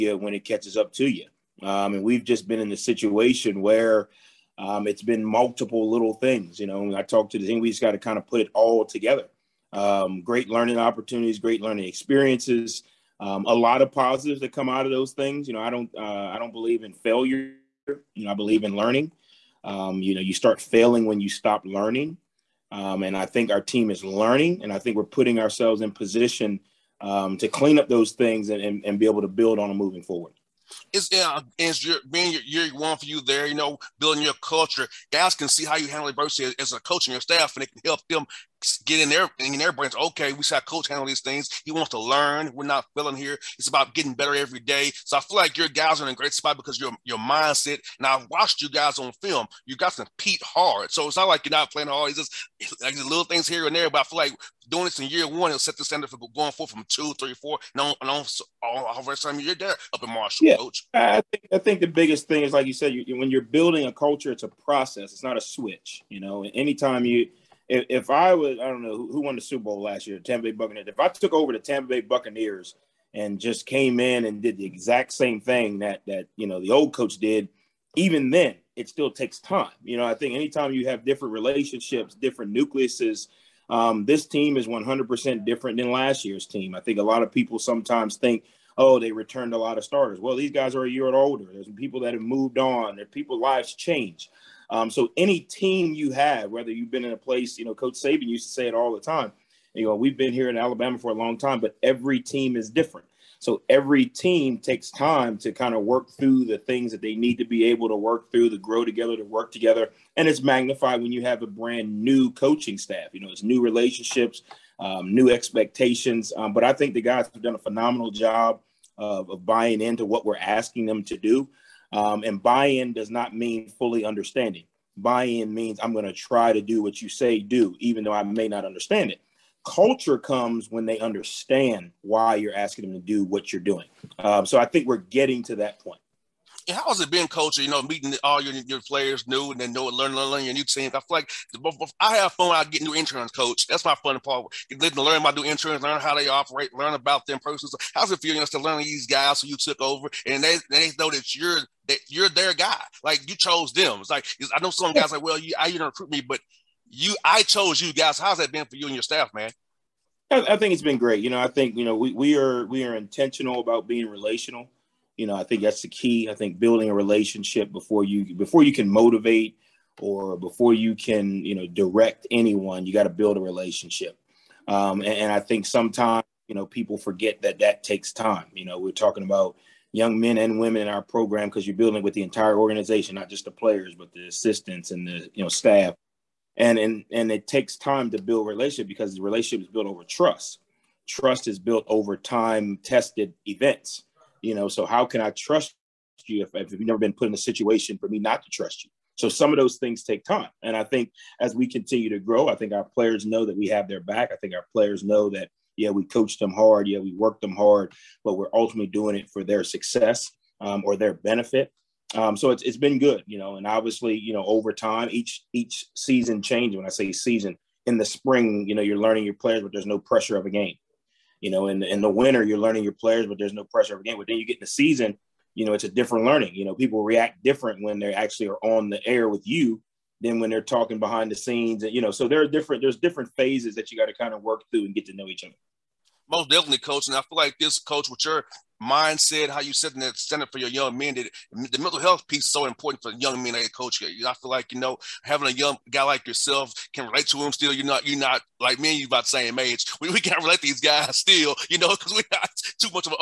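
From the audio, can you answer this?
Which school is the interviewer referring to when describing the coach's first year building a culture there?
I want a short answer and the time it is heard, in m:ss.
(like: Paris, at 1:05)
Marshall, at 1:00.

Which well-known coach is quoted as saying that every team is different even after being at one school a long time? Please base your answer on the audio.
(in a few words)
Coach Saban.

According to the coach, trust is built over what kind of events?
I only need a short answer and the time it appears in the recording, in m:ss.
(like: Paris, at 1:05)
time tested events, at 3:12.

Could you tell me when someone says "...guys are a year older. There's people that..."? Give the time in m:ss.
1:30.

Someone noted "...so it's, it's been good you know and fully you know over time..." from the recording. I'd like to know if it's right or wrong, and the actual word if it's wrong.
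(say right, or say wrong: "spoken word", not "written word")
wrong: "obviously", not "fully".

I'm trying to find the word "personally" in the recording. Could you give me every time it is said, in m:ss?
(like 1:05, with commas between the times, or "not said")
2:27.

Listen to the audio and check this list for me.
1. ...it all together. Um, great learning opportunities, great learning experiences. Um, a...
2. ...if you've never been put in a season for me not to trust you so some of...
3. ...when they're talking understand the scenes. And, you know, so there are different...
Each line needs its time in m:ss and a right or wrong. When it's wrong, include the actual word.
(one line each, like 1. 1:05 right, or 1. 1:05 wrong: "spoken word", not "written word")
1. 0:08 right
2. 3:16 wrong: "situation", not "season"
3. 3:50 wrong: "behind", not "understand".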